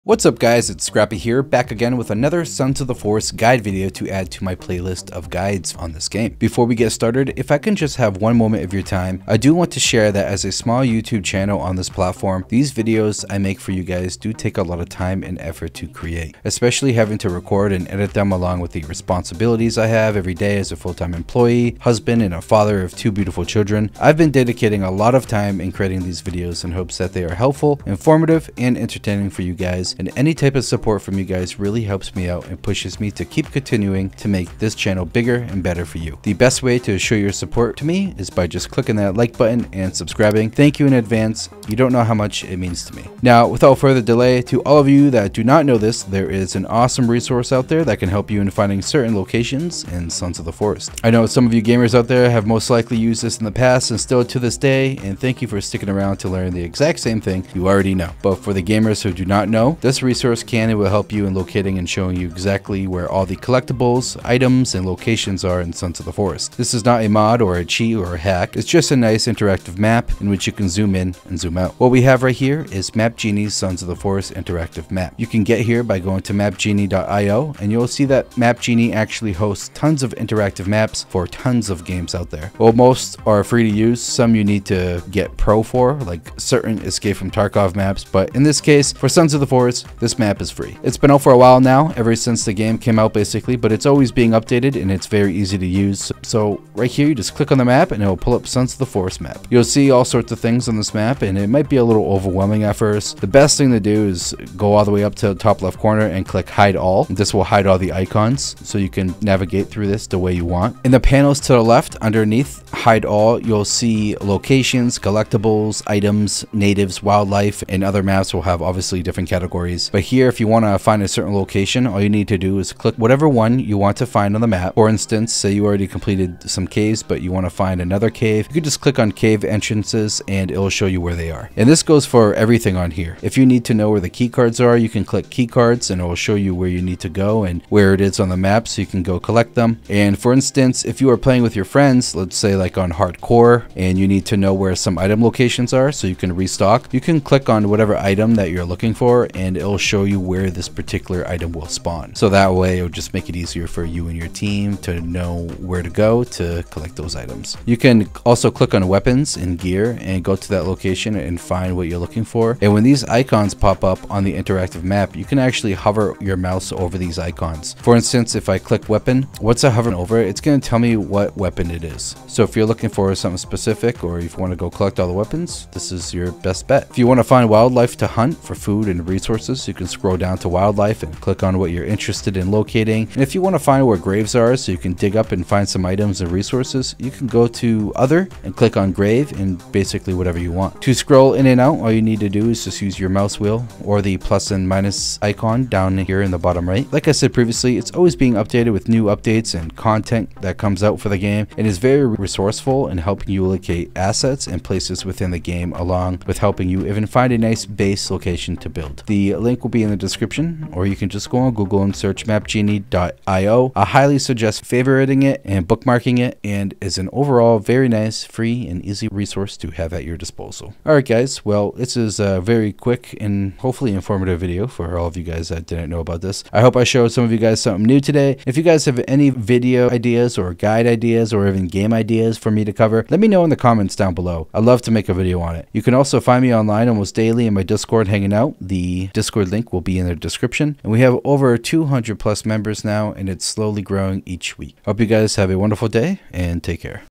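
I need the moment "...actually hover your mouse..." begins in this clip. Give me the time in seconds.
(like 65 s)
165 s.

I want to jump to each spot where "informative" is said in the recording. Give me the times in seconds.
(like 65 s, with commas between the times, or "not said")
27 s, 223 s.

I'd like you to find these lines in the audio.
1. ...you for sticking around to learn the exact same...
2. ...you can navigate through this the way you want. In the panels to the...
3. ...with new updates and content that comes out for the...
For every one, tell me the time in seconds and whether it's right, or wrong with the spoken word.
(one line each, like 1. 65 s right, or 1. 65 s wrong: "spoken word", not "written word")
1. 55 s right
2. 108 s right
3. 198 s right.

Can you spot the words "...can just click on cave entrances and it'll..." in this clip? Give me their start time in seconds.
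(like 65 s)
128 s.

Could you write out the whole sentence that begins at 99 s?
You'll see all sorts of things on this map and it might be a little overwhelming at first.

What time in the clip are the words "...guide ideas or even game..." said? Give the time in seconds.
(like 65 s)
230 s.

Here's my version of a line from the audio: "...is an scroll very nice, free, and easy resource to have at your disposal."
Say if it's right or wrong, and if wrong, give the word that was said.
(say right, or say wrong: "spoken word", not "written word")
wrong: "overall", not "scroll".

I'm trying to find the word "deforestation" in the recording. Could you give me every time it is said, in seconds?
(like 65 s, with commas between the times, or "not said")
not said.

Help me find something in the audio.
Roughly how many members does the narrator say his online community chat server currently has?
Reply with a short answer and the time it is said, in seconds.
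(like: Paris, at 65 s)
200, at 241 s.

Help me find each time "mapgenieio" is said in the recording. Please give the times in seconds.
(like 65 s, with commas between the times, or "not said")
76 s, 212 s.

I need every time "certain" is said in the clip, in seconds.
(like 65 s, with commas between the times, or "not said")
48 s, 86 s, 121 s.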